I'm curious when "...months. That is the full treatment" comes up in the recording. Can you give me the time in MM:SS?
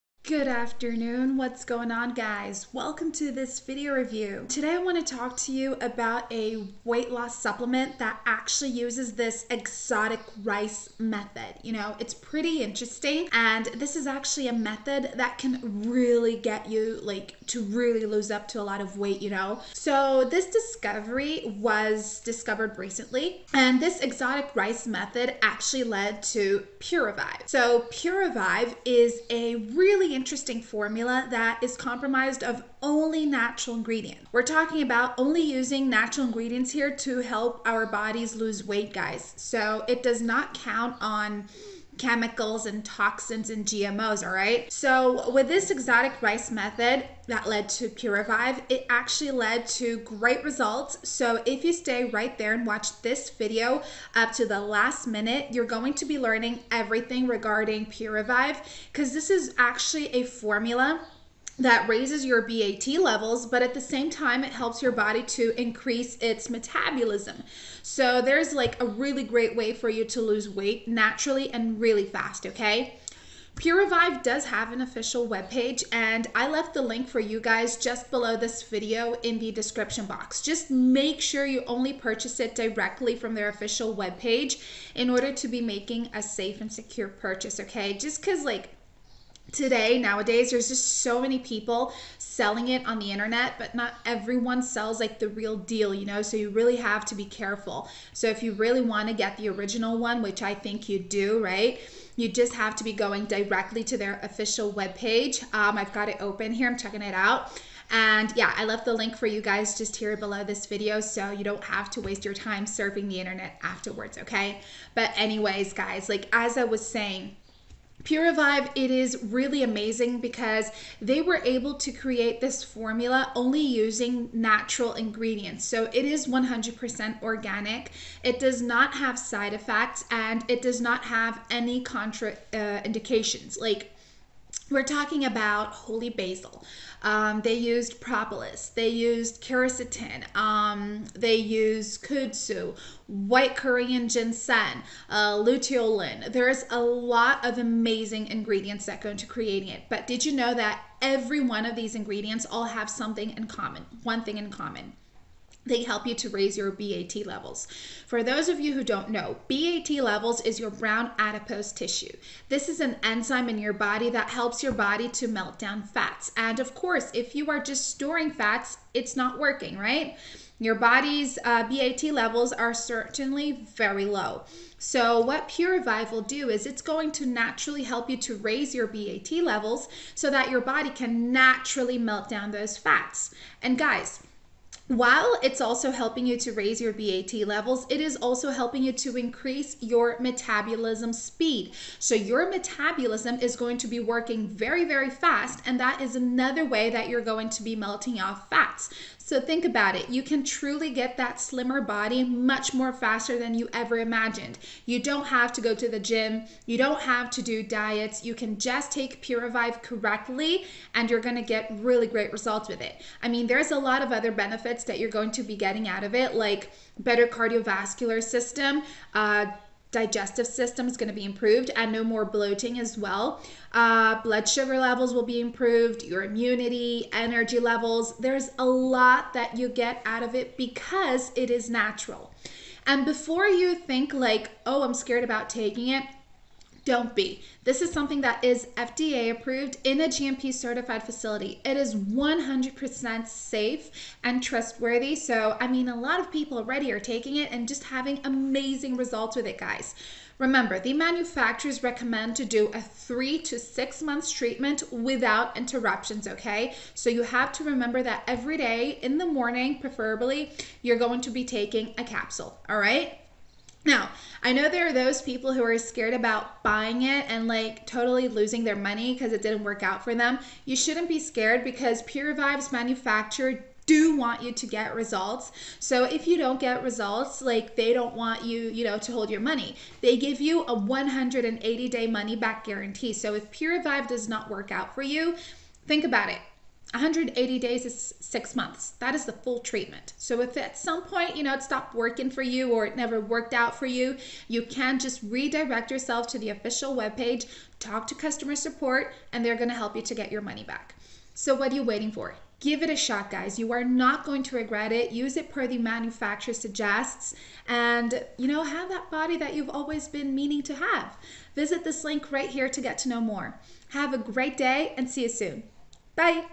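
04:48.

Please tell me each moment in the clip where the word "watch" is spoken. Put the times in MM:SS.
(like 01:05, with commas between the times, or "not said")
00:52.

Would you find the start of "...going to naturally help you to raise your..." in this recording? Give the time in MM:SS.
02:56.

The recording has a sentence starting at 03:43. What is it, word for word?
Uh, blood sugar levels will be improved, your immunity, energy levels.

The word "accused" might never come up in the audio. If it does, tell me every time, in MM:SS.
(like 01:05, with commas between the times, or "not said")
not said.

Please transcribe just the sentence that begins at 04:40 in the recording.
They give you a 180 day money back guarantee.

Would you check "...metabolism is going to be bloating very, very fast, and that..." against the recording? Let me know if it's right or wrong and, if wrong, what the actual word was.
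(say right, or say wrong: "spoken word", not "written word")
wrong: "working", not "bloating".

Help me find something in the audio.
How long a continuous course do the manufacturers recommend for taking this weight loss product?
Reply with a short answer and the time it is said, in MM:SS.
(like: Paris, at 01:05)
3 to 6 months, at 04:12.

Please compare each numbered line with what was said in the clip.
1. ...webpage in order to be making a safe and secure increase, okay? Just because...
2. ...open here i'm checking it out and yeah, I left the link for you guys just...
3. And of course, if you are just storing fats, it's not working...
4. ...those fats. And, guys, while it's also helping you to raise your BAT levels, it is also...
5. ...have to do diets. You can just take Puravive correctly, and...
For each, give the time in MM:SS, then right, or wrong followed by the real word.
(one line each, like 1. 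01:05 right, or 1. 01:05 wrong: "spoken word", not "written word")
1. 01:23 wrong: "purchase", not "increase"
2. 01:46 right
3. 02:46 right
4. 03:02 right
5. 03:26 right.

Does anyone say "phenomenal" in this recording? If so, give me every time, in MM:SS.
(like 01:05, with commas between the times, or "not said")
not said.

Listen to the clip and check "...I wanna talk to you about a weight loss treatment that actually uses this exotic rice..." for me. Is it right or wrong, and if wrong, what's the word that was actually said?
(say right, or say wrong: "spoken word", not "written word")
wrong: "supplement", not "treatment".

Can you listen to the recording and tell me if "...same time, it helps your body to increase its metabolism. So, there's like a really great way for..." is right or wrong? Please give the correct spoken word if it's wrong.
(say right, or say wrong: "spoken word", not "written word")
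right.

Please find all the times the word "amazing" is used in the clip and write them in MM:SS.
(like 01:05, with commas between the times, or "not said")
01:59, 02:27, 04:08.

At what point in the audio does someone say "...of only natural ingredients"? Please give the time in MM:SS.
00:32.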